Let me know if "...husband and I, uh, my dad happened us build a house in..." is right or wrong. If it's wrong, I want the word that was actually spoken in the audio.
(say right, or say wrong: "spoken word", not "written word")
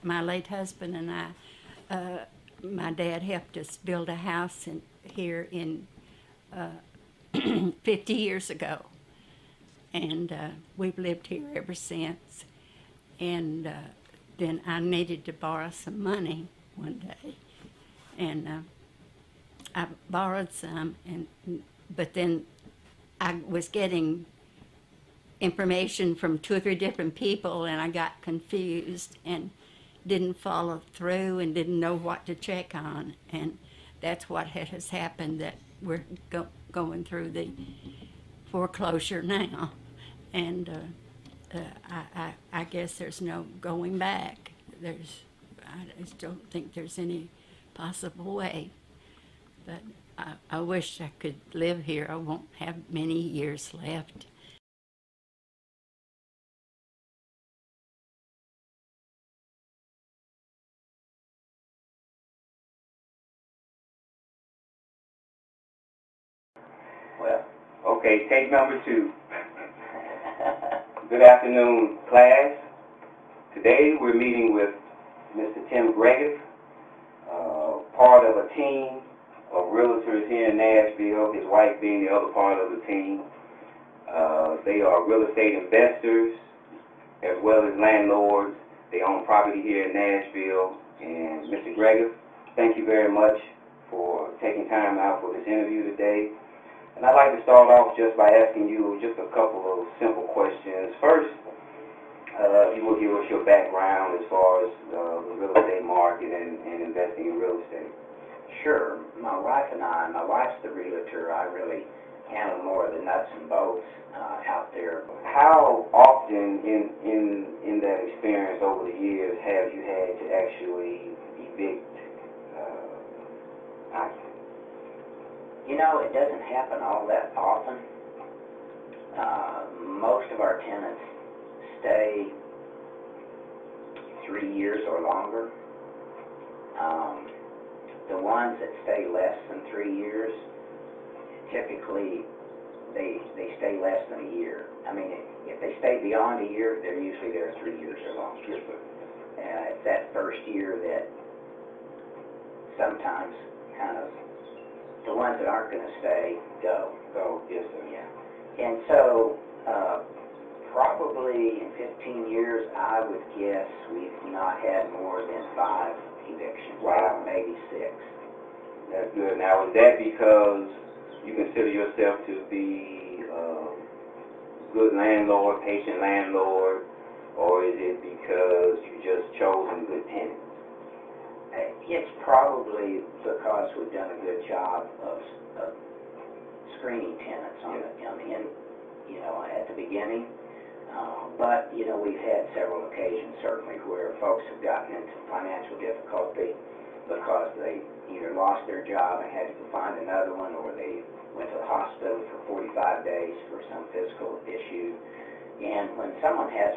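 wrong: "helped", not "happened".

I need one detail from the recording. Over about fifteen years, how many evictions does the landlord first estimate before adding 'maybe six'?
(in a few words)
5.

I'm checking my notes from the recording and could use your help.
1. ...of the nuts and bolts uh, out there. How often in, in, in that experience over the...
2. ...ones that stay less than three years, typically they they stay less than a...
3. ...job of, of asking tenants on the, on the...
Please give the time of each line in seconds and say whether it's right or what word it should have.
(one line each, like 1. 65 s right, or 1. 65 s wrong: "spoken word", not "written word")
1. 112 s right
2. 138 s right
3. 184 s wrong: "screening", not "asking".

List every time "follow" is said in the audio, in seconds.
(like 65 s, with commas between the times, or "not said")
30 s.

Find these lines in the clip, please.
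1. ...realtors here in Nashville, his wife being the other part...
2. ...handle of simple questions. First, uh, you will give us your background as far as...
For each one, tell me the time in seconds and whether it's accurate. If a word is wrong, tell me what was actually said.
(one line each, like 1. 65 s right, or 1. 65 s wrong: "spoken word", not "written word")
1. 79 s right
2. 99 s wrong: "couple", not "handle".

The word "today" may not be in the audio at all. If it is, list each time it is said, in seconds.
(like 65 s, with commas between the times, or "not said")
73 s, 95 s.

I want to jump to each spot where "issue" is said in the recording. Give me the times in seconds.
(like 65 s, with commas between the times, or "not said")
204 s.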